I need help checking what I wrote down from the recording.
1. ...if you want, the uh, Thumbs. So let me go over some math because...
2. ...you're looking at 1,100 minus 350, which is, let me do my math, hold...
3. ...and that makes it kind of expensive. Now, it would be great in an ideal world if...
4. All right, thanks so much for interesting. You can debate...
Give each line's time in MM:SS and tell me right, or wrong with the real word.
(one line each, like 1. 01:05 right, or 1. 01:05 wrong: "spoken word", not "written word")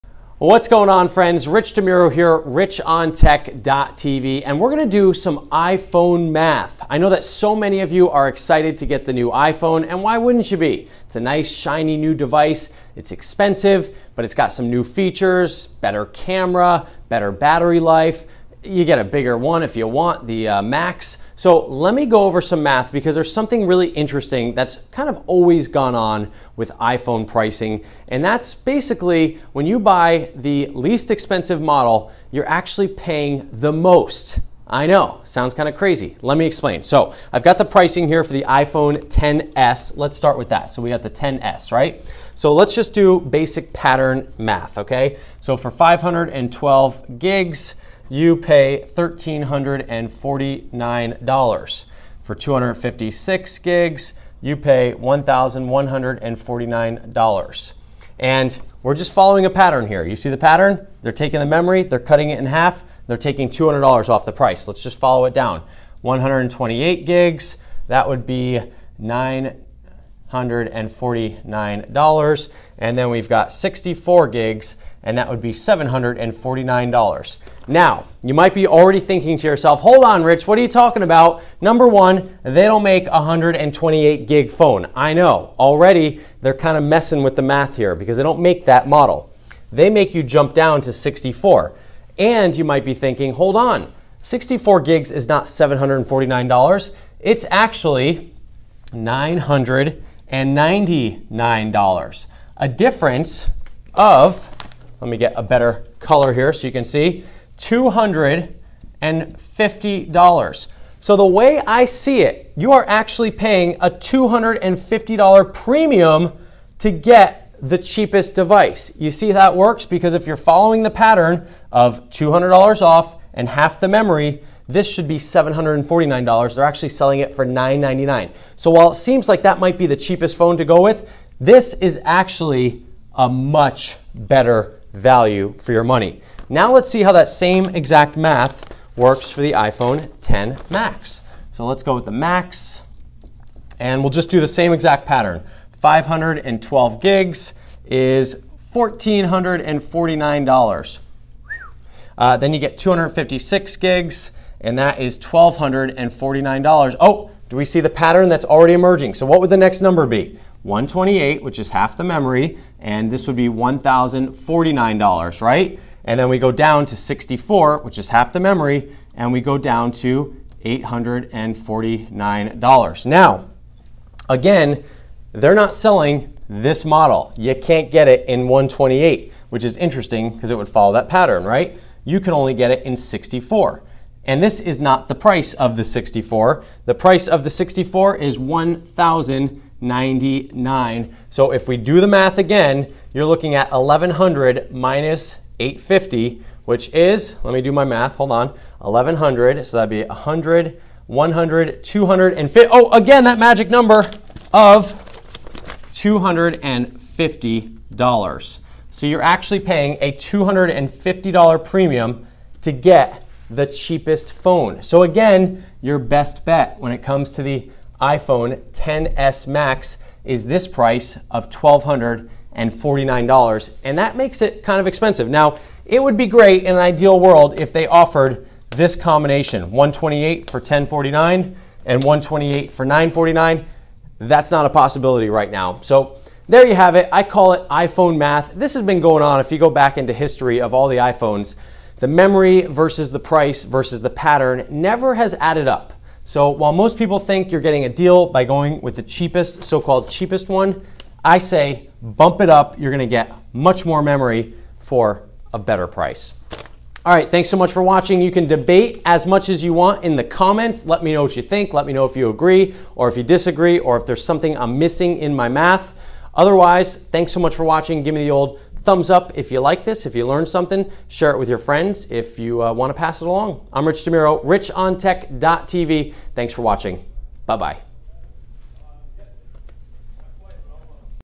1. 00:19 wrong: "Max", not "Thumbs"
2. 03:13 wrong: "850", not "350"
3. 03:43 right
4. 04:17 wrong: "watching", not "interesting".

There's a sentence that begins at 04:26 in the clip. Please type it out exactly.
Otherwise, thanks so much for watching.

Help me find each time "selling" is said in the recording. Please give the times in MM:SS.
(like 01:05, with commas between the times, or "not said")
02:06, 02:55.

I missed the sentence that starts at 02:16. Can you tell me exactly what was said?
Now let's see how that same exact math works for the iPhone 10 Max.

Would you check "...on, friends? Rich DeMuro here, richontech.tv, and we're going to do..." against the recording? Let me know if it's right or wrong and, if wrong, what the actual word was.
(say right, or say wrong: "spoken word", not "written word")
right.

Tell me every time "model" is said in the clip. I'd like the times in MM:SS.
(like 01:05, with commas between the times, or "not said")
00:31, 01:28, 02:56.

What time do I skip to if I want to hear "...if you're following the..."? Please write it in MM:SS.
02:00.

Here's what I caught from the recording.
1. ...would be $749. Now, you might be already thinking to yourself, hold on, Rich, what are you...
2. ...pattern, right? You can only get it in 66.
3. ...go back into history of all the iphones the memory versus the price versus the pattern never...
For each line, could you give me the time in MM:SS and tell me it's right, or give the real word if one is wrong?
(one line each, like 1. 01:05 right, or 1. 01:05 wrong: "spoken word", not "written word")
1. 01:15 right
2. 03:01 wrong: "64", not "66"
3. 03:59 right.